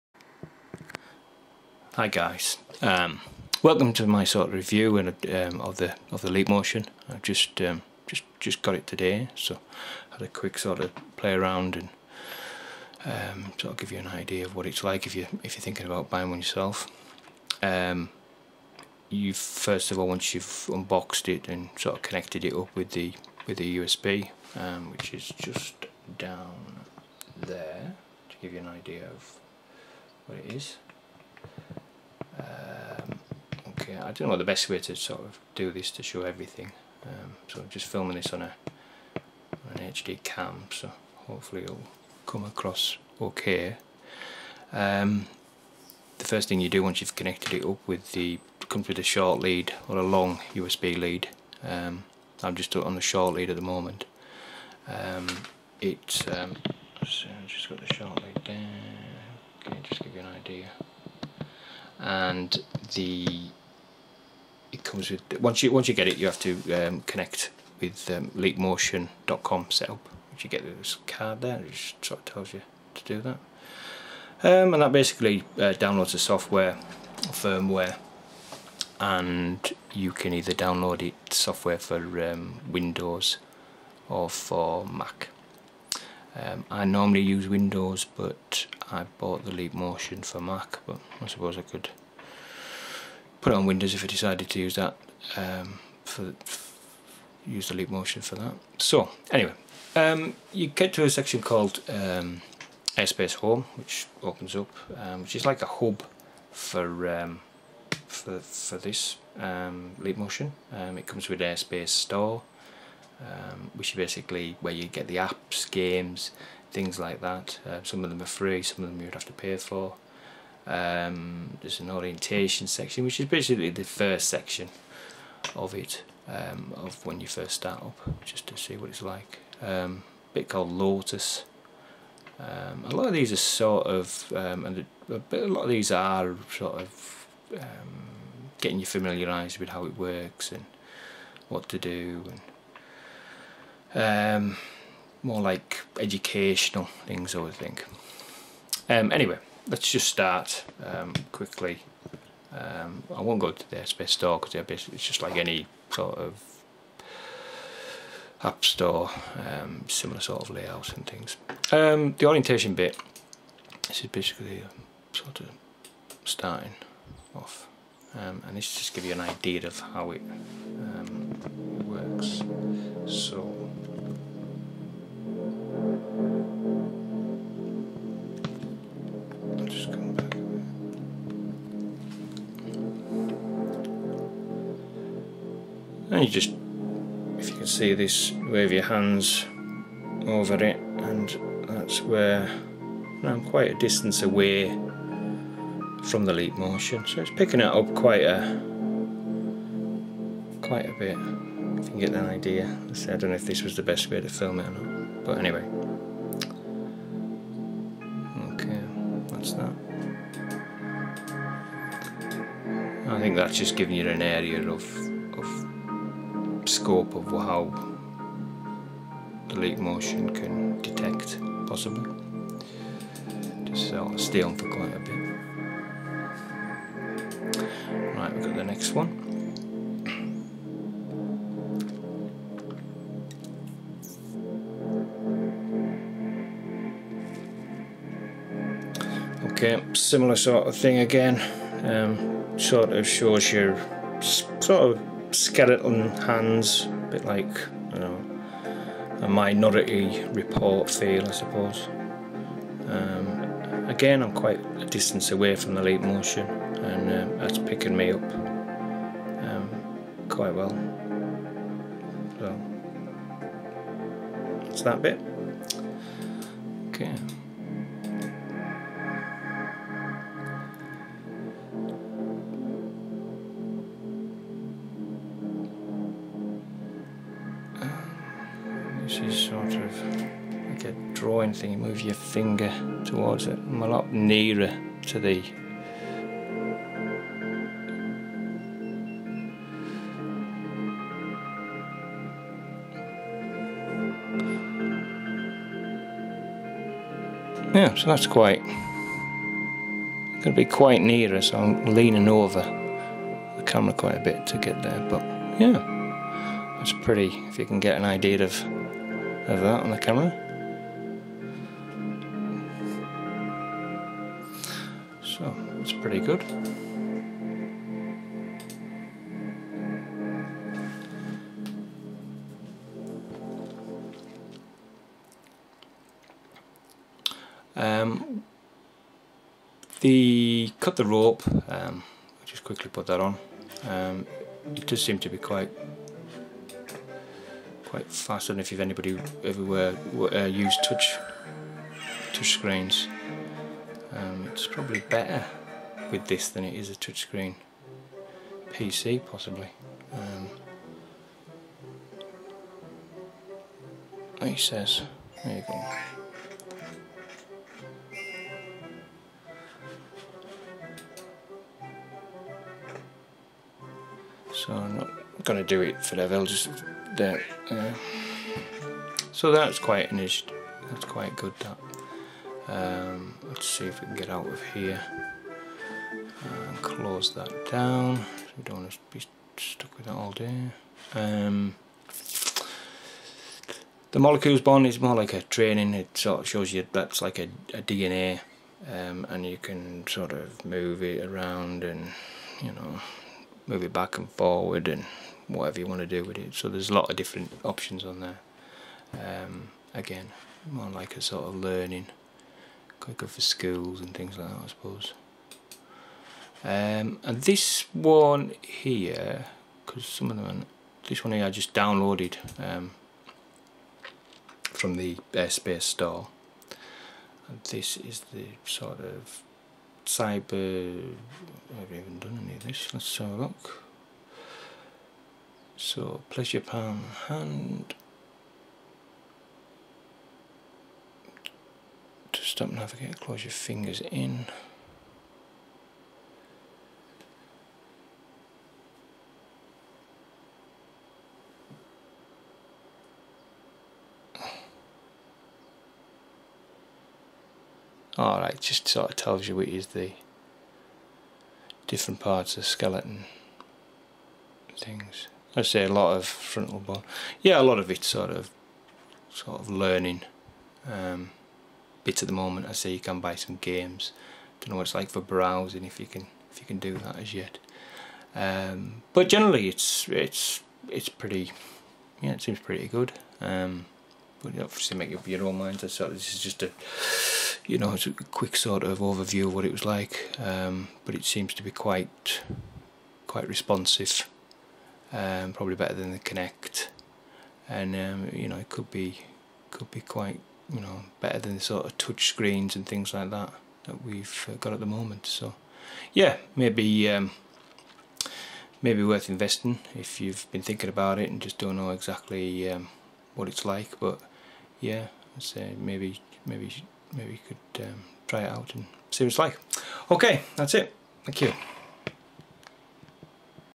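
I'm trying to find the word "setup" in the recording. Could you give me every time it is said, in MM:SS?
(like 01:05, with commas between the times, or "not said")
01:09.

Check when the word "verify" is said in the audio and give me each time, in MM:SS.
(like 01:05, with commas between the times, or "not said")
not said.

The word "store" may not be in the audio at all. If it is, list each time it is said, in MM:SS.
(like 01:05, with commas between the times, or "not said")
01:51, 02:34, 02:38, 06:55.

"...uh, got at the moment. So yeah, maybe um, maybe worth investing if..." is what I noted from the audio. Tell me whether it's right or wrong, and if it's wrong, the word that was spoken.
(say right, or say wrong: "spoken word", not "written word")
right.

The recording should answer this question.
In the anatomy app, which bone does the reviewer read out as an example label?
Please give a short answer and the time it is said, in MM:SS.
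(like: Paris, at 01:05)
frontal bone, at 07:36.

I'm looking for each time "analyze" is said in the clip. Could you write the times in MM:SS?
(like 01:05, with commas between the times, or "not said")
not said.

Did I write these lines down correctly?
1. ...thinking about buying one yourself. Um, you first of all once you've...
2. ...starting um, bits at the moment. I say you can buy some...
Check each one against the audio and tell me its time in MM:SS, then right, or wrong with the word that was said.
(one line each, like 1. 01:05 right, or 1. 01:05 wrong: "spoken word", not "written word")
1. 00:15 right
2. 07:39 wrong: "learning", not "starting".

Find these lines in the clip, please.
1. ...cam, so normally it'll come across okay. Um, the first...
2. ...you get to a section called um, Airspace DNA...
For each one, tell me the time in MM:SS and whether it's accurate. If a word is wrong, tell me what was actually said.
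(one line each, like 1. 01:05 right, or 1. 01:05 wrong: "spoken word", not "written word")
1. 00:40 wrong: "hopefully", not "normally"
2. 01:40 wrong: "Home", not "DNA".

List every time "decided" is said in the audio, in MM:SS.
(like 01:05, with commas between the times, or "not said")
01:34.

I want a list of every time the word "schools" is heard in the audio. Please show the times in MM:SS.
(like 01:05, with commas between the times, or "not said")
06:43.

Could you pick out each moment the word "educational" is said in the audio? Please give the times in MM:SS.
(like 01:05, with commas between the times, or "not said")
02:25.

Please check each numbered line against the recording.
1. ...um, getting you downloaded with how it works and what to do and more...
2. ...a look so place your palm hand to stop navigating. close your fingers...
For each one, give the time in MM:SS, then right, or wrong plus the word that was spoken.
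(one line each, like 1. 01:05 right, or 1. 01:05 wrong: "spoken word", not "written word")
1. 02:17 wrong: "familiarised", not "downloaded"
2. 07:03 right.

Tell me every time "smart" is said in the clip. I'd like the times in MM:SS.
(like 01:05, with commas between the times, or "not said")
not said.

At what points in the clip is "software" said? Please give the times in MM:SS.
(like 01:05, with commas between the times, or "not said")
01:16, 01:21.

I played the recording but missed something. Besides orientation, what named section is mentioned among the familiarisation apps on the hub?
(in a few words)
Lotus.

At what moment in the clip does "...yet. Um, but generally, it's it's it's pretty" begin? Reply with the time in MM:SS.
07:47.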